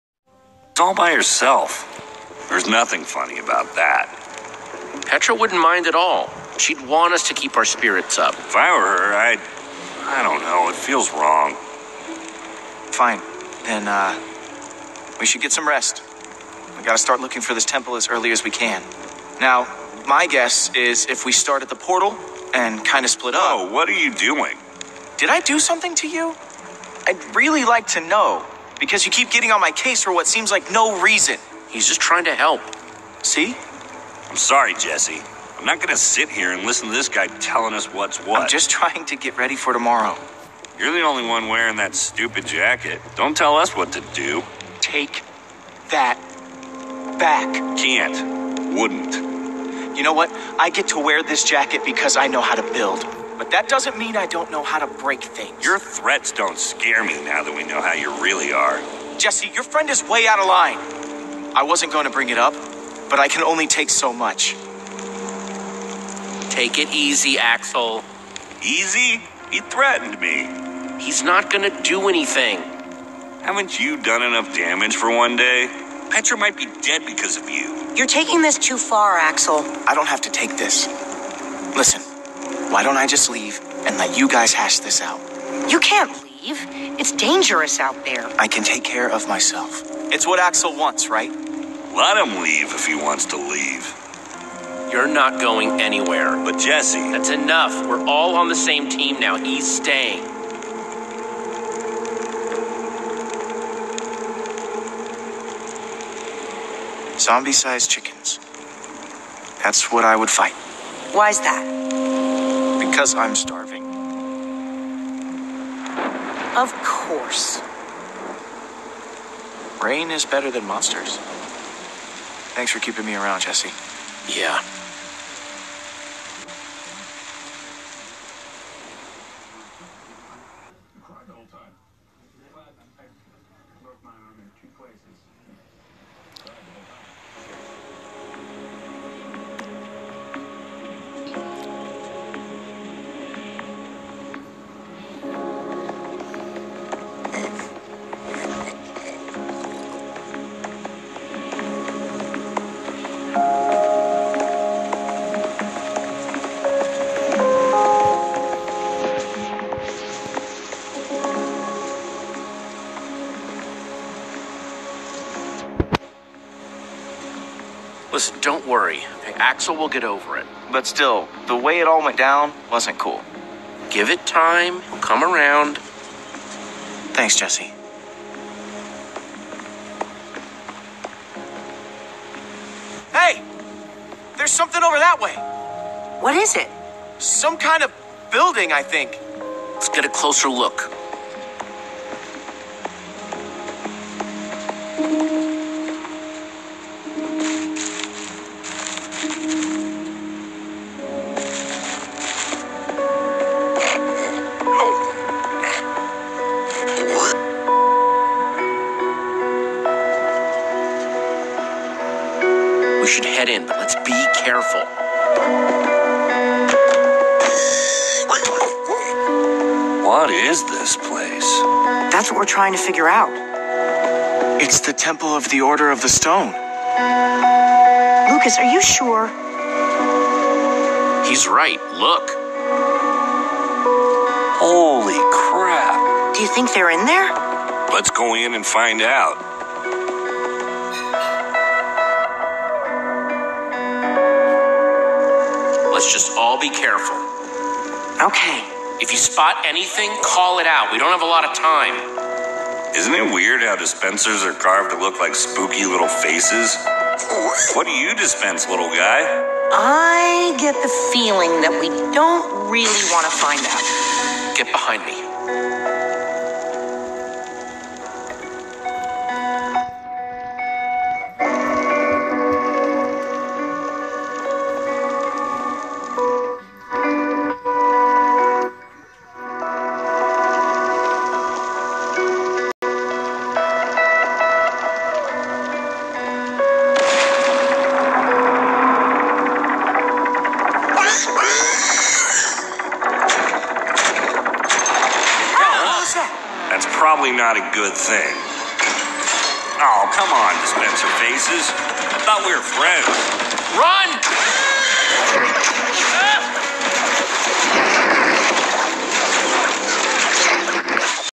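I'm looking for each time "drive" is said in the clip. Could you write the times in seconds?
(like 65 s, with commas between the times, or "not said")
not said.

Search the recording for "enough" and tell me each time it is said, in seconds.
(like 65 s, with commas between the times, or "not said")
74 s, 97 s.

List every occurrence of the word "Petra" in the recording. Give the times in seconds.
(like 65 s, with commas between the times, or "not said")
5 s, 76 s.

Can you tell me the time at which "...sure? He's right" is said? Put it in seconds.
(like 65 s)
228 s.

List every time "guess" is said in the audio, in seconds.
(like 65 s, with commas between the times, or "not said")
20 s.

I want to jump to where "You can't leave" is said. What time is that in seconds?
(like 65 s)
85 s.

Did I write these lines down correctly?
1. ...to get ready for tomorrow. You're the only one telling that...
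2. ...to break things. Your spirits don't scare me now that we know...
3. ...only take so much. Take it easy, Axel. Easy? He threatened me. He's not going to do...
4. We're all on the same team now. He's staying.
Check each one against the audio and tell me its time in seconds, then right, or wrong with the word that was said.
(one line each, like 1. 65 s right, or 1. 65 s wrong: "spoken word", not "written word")
1. 39 s wrong: "wearing", not "telling"
2. 54 s wrong: "threats", not "spirits"
3. 63 s right
4. 97 s right.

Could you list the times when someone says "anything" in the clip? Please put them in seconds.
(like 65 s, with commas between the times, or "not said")
72 s, 249 s.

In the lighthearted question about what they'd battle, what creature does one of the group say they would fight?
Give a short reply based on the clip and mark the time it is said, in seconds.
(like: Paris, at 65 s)
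Zombie sized chickens, at 107 s.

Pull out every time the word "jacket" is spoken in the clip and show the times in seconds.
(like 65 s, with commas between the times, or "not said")
42 s, 51 s.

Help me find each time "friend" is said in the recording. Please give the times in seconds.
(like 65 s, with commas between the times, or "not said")
59 s, 302 s.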